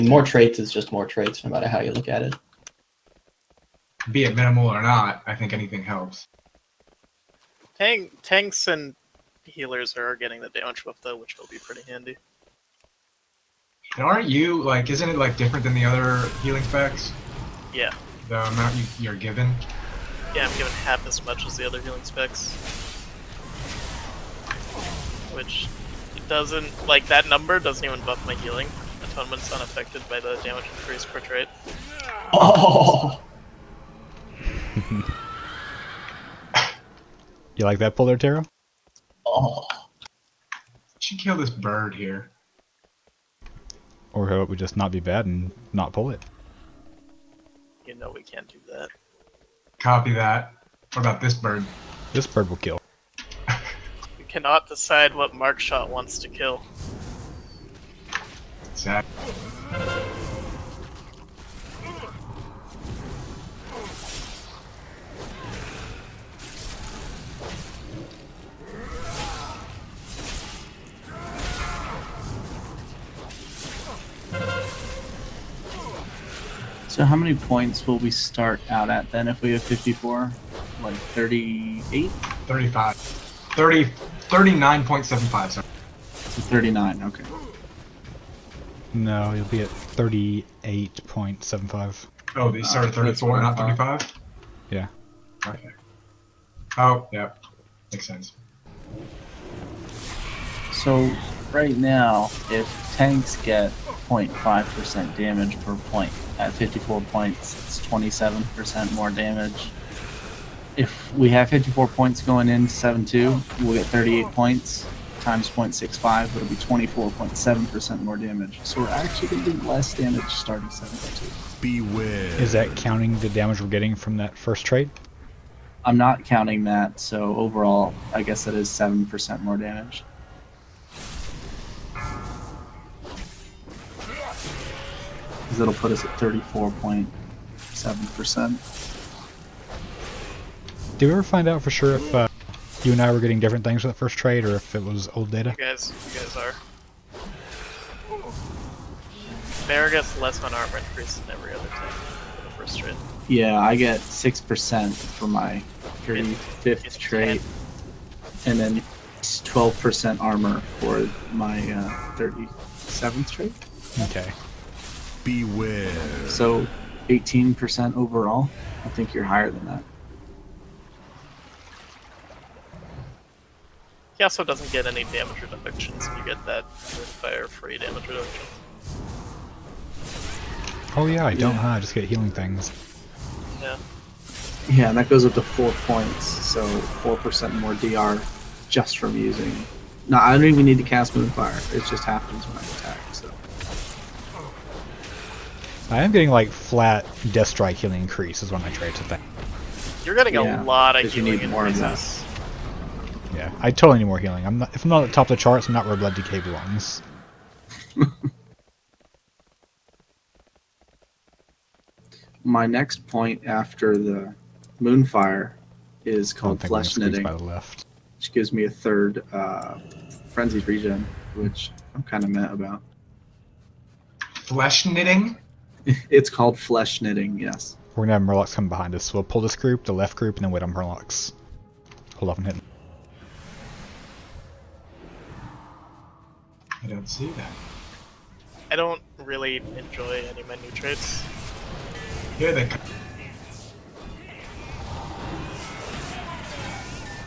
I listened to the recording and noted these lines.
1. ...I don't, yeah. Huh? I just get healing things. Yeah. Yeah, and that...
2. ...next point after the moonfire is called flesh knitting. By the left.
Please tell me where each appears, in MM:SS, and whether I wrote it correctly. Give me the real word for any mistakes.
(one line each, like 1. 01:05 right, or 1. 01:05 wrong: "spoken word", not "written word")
1. 03:01 right
2. 03:32 right.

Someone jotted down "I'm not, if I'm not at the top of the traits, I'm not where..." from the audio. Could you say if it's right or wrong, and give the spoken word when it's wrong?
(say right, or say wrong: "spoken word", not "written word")
wrong: "charts", not "traits".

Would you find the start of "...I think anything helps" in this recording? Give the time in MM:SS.
00:05.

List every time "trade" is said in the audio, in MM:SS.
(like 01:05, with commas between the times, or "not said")
02:43, 03:18.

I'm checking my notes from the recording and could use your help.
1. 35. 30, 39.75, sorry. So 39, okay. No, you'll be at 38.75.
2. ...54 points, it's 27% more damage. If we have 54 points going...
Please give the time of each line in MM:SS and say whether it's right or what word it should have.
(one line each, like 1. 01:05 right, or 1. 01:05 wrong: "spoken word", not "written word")
1. 01:22 right
2. 01:46 right.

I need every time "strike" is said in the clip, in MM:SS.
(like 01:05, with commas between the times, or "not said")
03:17.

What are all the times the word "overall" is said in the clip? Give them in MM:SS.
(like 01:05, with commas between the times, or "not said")
02:07, 02:47.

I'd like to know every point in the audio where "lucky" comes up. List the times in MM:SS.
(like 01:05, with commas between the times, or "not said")
not said.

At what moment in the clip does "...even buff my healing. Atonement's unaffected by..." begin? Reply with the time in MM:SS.
00:27.